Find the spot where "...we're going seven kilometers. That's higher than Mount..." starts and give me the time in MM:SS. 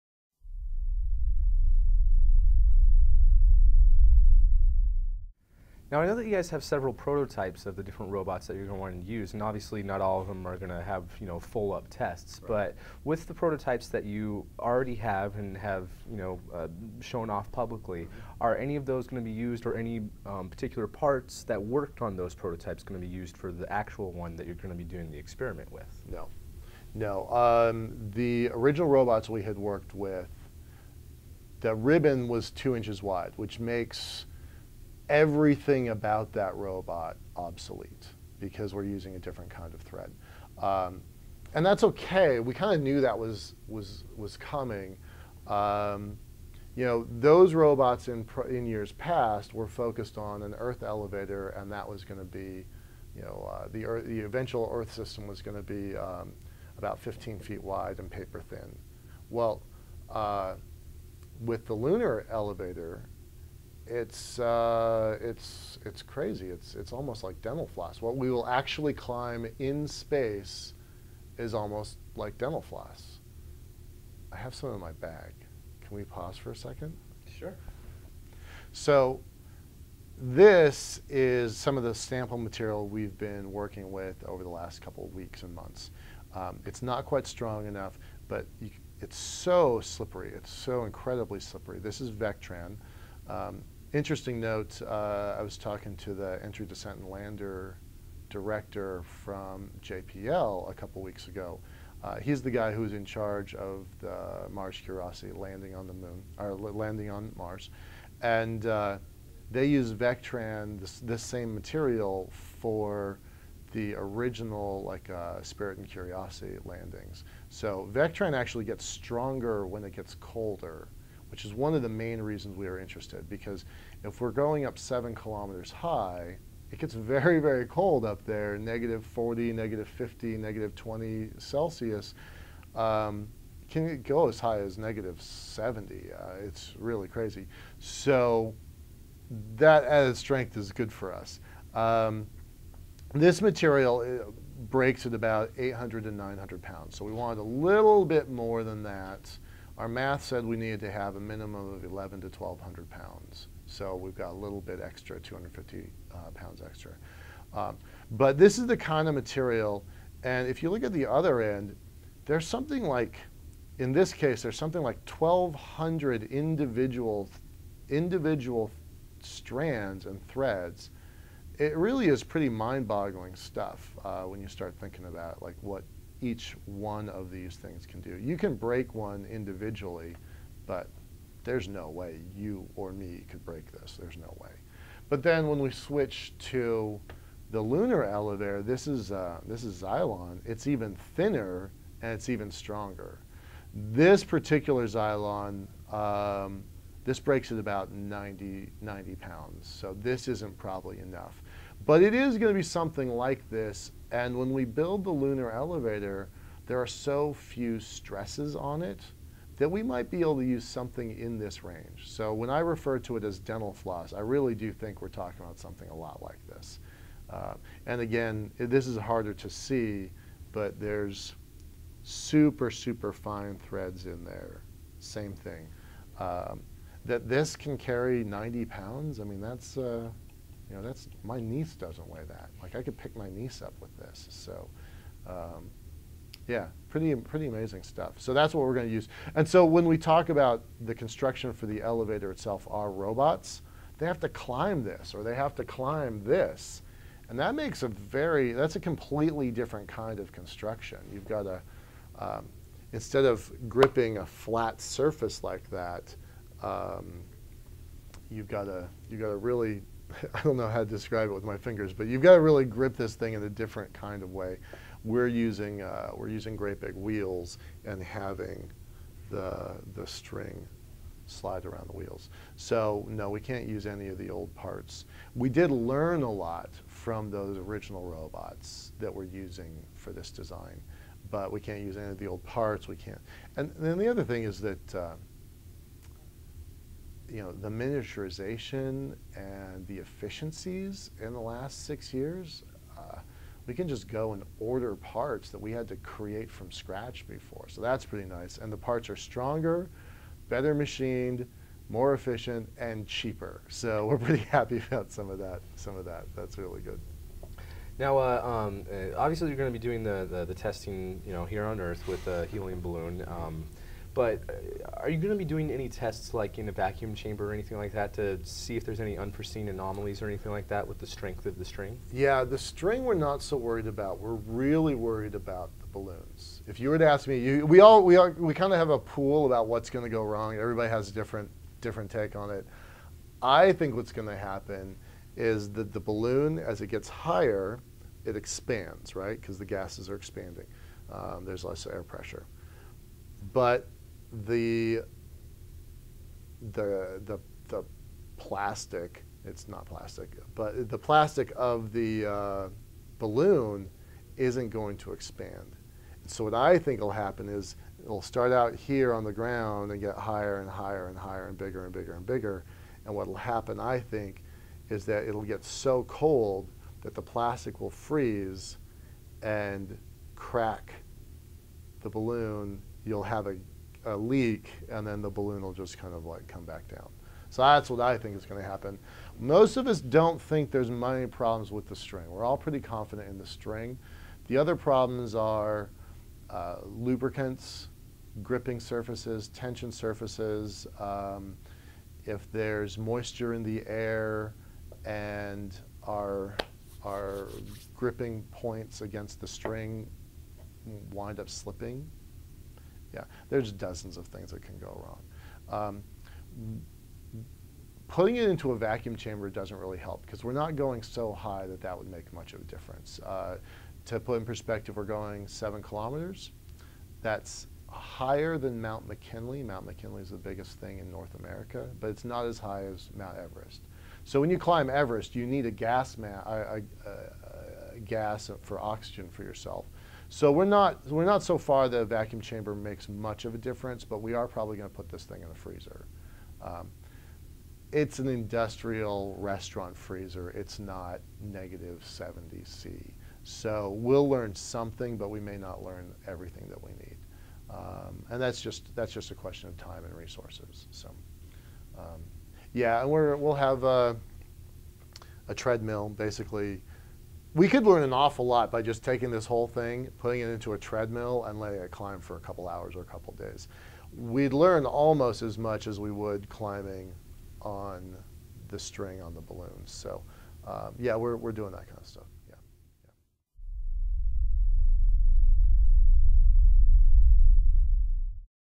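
06:54.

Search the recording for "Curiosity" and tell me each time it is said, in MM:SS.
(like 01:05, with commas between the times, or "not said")
01:44, 01:55.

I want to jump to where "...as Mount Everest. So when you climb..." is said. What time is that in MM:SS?
07:02.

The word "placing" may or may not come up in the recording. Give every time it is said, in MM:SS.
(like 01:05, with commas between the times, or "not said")
not said.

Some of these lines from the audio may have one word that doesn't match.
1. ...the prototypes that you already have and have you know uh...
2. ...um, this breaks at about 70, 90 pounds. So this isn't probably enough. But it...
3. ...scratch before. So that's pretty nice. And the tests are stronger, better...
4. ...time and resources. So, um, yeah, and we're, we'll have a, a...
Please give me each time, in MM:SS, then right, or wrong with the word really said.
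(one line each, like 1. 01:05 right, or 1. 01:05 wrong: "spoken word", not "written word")
1. 00:13 right
2. 03:15 wrong: "90", not "70"
3. 04:56 wrong: "parts", not "tests"
4. 07:29 right.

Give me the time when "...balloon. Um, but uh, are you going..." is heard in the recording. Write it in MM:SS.
05:12.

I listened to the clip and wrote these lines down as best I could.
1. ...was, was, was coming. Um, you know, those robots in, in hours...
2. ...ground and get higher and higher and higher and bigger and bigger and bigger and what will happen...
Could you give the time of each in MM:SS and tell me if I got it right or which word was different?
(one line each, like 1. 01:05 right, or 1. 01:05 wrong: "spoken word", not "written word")
1. 00:43 wrong: "years", not "hours"
2. 05:59 right.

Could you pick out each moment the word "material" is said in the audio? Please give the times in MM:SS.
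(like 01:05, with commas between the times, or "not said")
01:22, 01:51, 02:23, 02:39.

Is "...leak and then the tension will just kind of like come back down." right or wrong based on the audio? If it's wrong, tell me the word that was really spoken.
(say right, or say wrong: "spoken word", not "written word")
wrong: "balloon", not "tension".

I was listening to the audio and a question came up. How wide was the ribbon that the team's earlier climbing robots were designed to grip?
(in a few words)
2 inches.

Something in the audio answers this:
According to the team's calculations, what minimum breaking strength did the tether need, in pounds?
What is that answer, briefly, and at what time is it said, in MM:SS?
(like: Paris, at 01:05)
1,100 to 1,200 pounds, at 02:31.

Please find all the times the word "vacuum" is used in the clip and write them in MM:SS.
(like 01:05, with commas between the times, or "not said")
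05:16, 06:48, 07:12.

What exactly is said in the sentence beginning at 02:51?
It really is pretty mind-boggling stuff uh, when you start thinking about like what each one of these things can do.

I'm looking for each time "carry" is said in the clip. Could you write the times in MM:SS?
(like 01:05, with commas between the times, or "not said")
03:47.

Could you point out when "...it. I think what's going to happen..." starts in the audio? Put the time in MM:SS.
05:32.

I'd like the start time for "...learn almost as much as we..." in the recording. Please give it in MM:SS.
07:44.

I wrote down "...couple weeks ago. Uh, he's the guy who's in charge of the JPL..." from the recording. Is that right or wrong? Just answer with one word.
wrong.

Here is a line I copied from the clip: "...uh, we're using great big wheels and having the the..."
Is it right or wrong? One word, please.
right.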